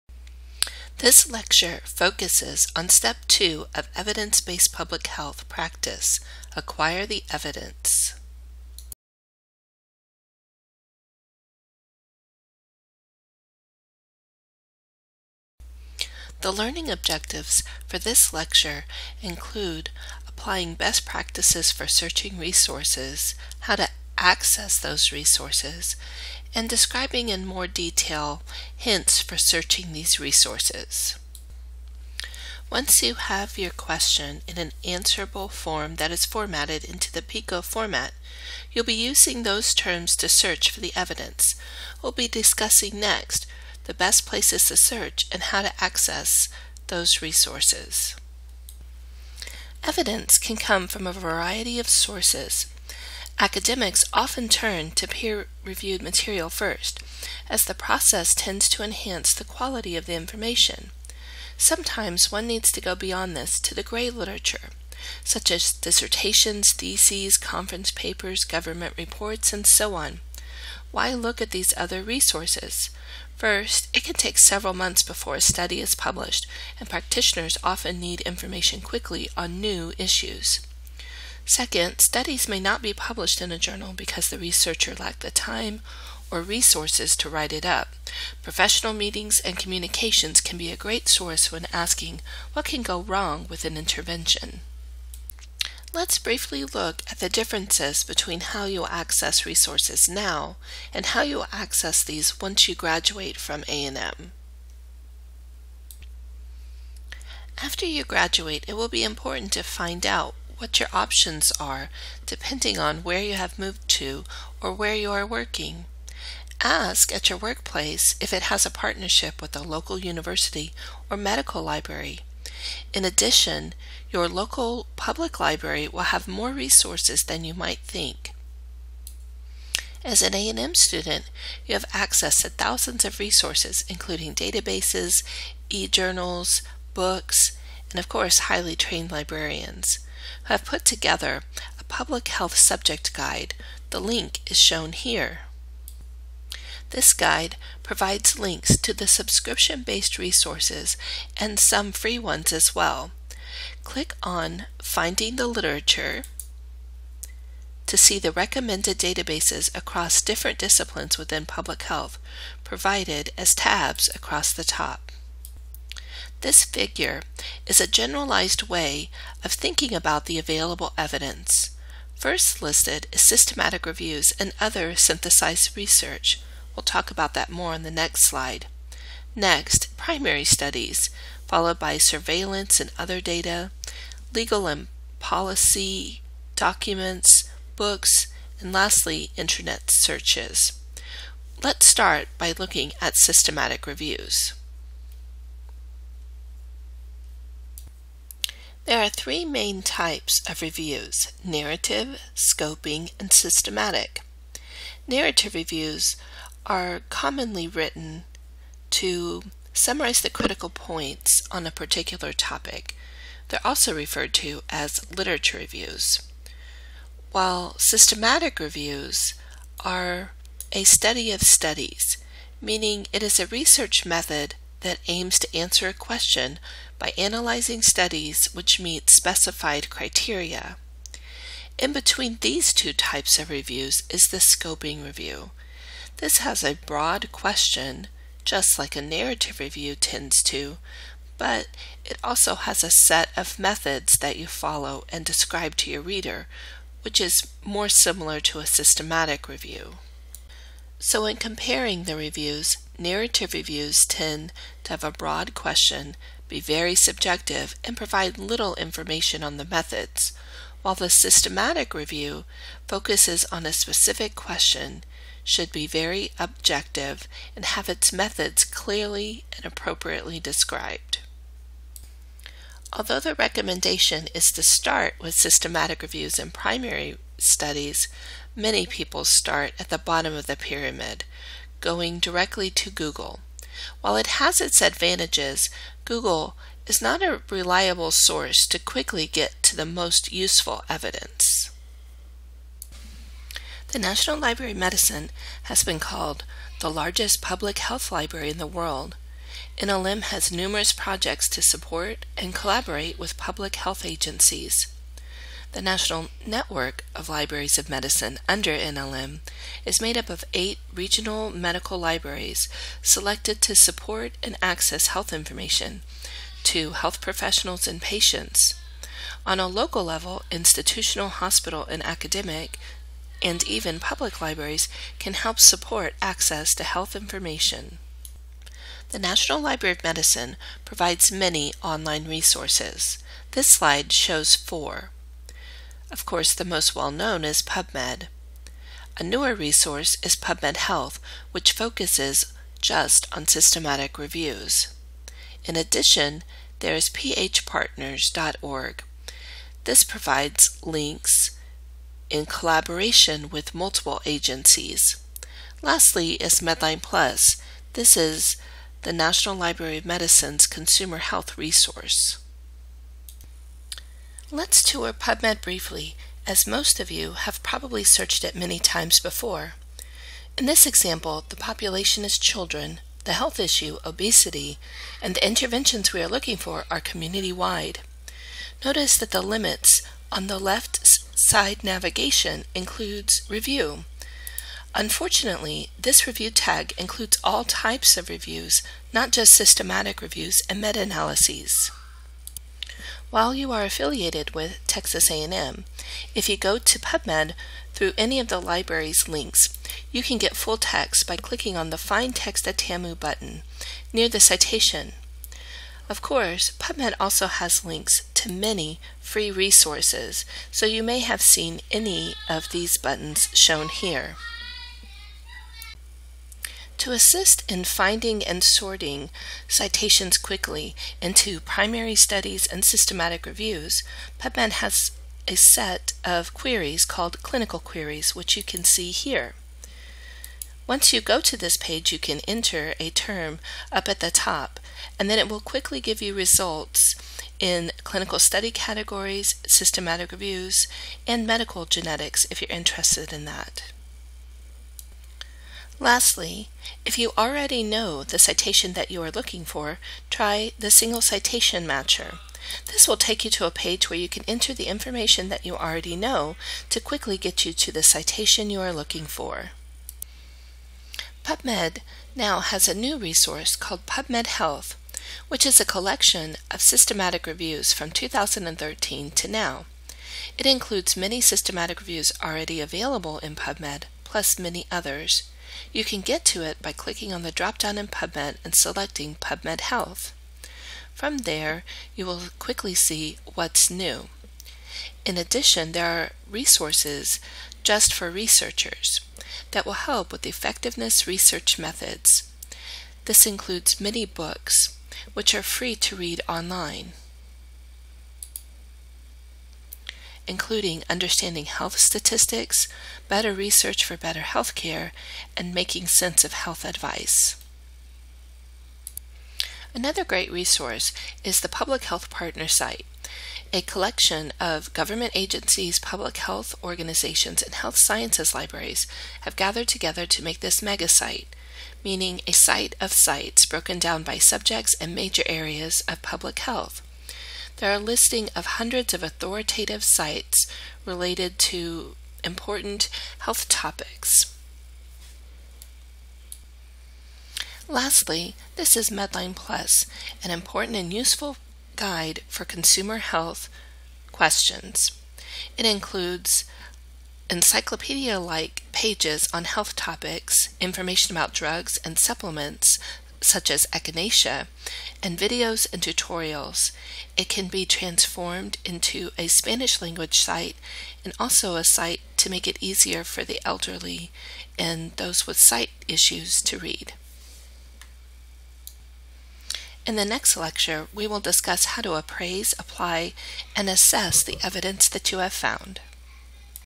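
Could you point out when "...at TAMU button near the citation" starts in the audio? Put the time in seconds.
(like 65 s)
402 s.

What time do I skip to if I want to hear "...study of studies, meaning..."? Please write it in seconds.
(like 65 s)
220 s.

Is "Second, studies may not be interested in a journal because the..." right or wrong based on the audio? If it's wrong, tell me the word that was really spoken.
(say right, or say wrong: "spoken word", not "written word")
wrong: "published", not "interested".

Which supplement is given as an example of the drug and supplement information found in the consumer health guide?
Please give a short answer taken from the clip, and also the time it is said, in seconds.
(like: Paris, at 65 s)
Echinacea, at 553 s.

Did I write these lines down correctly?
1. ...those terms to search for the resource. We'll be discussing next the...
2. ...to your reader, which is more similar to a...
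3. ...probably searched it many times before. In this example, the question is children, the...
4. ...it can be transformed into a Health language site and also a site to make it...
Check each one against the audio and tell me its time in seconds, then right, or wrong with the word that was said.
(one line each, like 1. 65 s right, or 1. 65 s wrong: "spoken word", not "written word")
1. 39 s wrong: "evidence", not "resource"
2. 245 s right
3. 367 s wrong: "population", not "question"
4. 557 s wrong: "Spanish", not "Health".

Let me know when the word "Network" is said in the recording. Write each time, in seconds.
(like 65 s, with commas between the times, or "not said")
306 s.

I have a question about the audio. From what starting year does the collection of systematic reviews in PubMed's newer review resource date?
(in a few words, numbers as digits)
2013.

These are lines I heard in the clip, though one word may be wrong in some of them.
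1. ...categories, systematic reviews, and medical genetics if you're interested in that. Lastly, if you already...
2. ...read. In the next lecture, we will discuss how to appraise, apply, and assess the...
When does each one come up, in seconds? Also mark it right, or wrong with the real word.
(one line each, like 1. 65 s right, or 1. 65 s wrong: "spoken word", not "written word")
1. 438 s right
2. 566 s right.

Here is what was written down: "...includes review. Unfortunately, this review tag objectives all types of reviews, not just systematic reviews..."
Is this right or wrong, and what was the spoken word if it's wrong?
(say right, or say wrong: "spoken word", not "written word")
wrong: "includes", not "objectives".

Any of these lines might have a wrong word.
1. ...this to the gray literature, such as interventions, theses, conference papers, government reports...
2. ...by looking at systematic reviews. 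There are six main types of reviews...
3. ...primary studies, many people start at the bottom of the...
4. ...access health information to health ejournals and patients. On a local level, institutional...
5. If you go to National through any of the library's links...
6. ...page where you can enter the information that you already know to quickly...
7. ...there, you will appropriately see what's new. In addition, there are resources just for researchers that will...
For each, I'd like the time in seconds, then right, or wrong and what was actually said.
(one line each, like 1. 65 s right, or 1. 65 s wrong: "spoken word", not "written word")
1. 63 s wrong: "dissertations", not "interventions"
2. 192 s wrong: "three", not "six"
3. 276 s right
4. 314 s wrong: "professionals", not "ejournals"
5. 396 s wrong: "PubMed", not "National"
6. 453 s right
7. 481 s wrong: "quickly", not "appropriately".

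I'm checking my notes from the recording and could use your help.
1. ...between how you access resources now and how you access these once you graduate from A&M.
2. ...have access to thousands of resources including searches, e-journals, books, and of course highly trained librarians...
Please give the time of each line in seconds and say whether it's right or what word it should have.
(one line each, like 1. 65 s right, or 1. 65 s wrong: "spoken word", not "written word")
1. 98 s right
2. 131 s wrong: "databases", not "searches".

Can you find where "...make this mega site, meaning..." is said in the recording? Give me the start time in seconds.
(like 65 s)
520 s.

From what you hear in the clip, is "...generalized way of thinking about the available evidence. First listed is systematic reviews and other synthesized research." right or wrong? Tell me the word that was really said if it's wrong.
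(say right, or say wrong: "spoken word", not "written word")
right.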